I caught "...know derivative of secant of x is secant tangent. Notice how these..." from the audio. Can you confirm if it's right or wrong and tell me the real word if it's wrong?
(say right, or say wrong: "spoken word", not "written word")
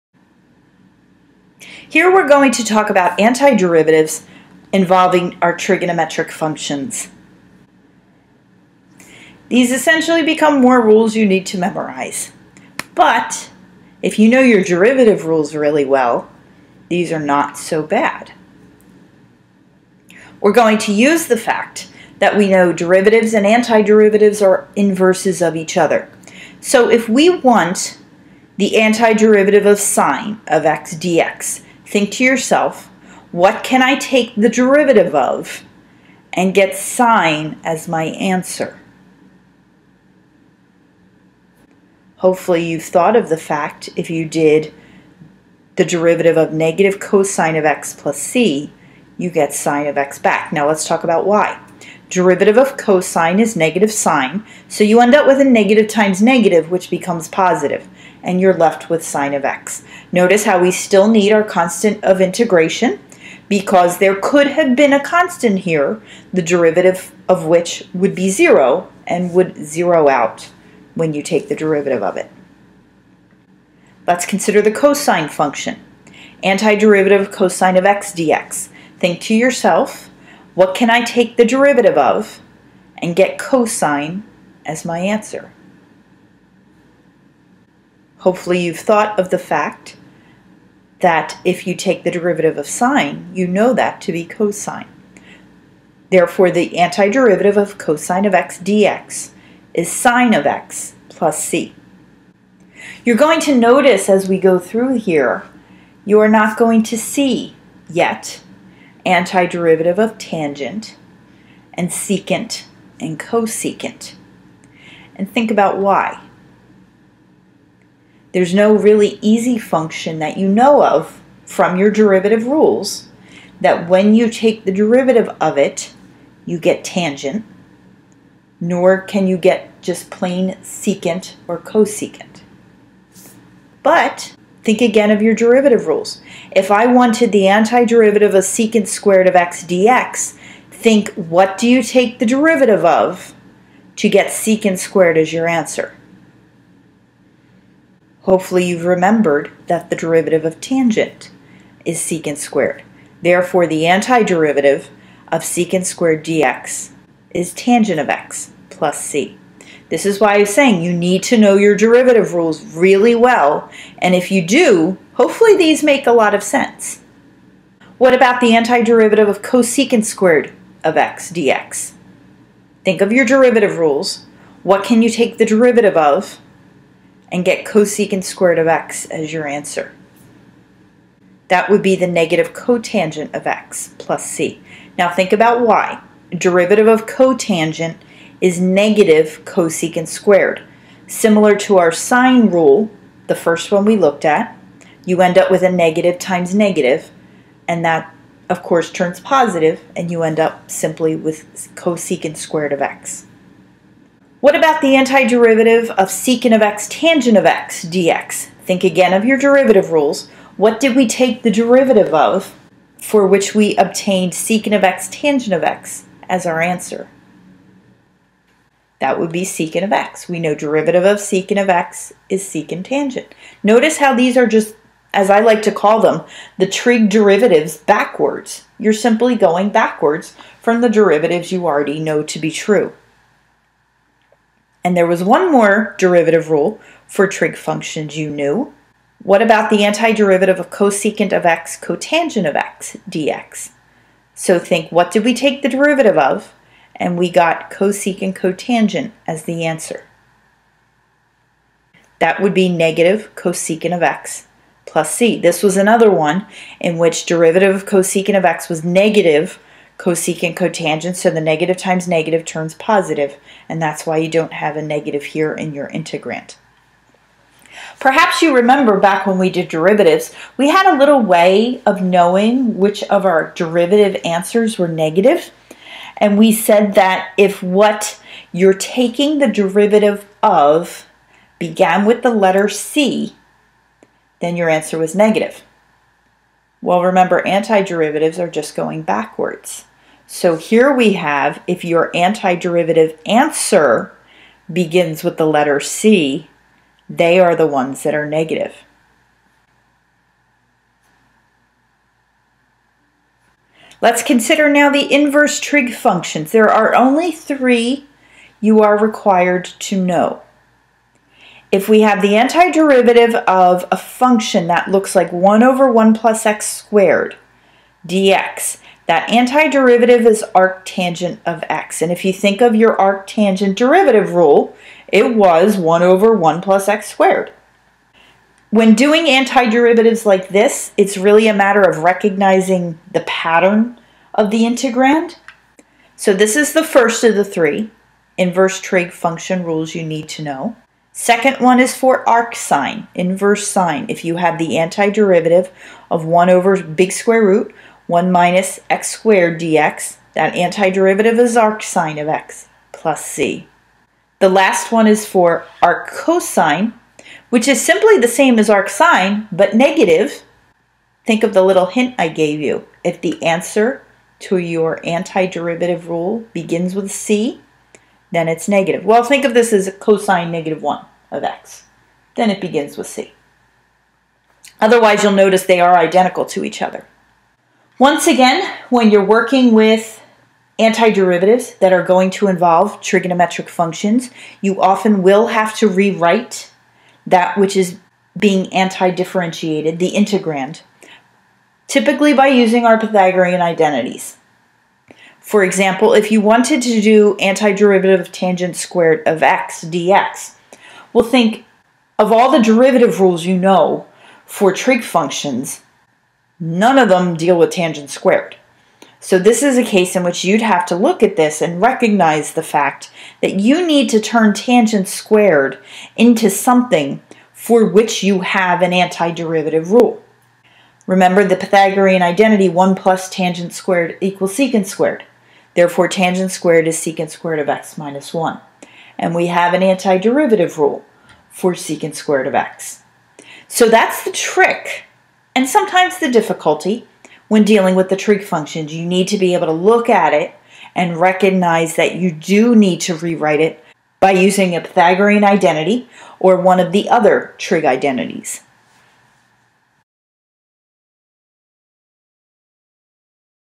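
right.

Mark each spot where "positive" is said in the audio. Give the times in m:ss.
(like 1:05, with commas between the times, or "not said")
0:57, 3:19, 4:22.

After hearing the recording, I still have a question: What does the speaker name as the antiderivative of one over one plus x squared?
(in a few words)
arctangent of x.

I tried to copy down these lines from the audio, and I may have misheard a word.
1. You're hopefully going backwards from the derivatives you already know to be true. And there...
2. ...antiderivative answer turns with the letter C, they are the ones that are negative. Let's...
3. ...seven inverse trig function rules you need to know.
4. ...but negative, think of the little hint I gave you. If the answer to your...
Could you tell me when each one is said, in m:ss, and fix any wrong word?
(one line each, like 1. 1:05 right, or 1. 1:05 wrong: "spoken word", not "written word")
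1. 3:48 wrong: "simply", not "hopefully"
2. 4:52 wrong: "begins", not "turns"
3. 5:37 wrong: "three", not "seven"
4. 5:59 right.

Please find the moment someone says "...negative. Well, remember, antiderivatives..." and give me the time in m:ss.
4:45.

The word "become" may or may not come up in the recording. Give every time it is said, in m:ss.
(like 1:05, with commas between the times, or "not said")
0:10, 0:56.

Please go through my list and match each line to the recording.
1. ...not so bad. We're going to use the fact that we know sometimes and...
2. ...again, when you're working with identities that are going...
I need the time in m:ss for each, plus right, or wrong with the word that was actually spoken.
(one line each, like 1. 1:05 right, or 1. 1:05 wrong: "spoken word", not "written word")
1. 0:17 wrong: "derivatives", not "sometimes"
2. 6:18 wrong: "antiderivatives", not "identities".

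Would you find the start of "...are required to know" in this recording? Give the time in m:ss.
5:08.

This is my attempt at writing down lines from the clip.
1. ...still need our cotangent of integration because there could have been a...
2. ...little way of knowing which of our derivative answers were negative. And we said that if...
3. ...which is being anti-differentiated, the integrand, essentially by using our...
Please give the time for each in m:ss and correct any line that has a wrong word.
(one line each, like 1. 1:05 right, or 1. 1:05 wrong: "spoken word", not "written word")
1. 1:00 wrong: "constant", not "cotangent"
2. 4:30 right
3. 6:27 wrong: "typically", not "essentially".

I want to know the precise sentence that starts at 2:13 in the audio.
But Think again of your derivative rules.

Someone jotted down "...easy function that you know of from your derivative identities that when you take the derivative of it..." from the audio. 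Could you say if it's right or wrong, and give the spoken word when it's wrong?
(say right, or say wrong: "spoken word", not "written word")
wrong: "rules", not "identities".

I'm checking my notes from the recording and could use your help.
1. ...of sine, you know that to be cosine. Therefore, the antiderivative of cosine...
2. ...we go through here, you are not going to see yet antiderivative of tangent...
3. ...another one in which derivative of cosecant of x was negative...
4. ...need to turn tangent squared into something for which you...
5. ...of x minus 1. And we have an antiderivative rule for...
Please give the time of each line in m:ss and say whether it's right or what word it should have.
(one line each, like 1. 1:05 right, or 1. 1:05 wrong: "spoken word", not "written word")
1. 1:32 right
2. 1:44 right
3. 4:15 right
4. 6:53 right
5. 7:07 right.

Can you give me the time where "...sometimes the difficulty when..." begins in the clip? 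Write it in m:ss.
7:15.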